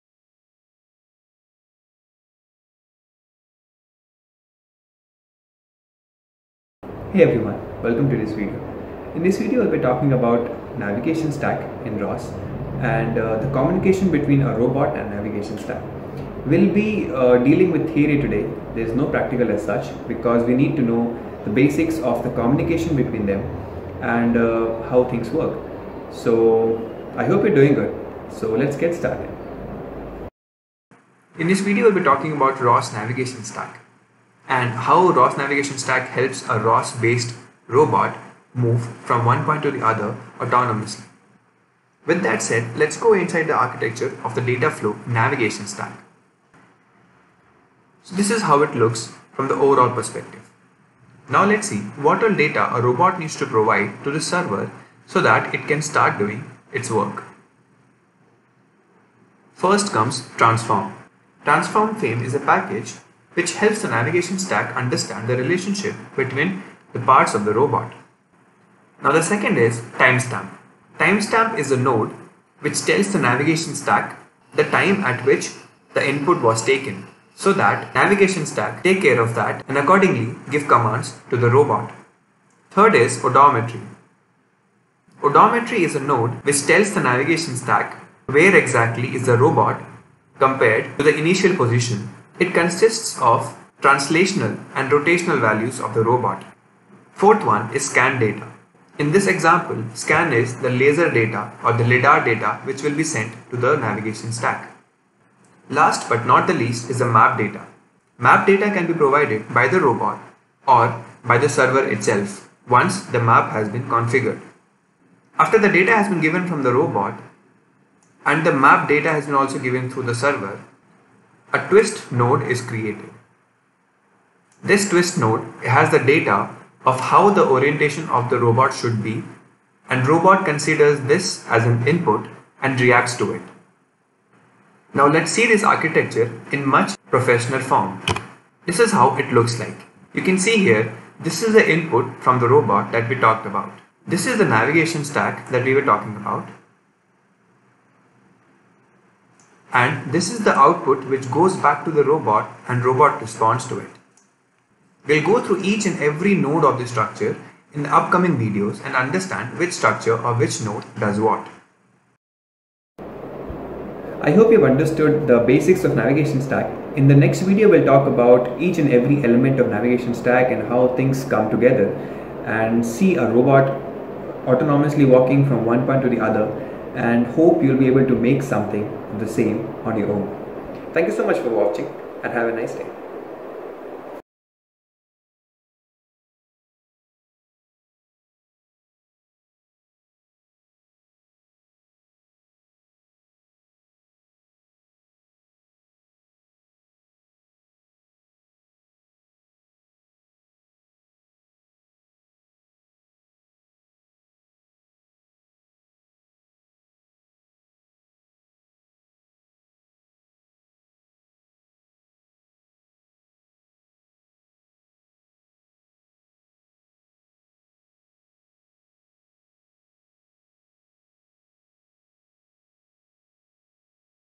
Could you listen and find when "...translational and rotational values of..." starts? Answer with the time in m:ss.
1:33.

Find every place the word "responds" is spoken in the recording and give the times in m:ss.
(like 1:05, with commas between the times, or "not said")
2:33.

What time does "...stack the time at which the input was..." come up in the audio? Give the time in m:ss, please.
1:13.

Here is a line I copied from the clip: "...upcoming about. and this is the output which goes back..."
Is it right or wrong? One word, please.
wrong.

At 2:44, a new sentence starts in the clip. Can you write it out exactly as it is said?
I hope you've understood the basics of navigation stack.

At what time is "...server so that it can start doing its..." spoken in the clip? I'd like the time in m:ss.
0:54.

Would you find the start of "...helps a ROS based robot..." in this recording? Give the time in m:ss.
0:36.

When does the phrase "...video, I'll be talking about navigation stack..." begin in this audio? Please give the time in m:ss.
0:09.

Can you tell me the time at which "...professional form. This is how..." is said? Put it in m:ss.
2:17.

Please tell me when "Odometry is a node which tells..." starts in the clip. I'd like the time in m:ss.
1:25.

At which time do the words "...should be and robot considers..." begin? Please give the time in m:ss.
2:08.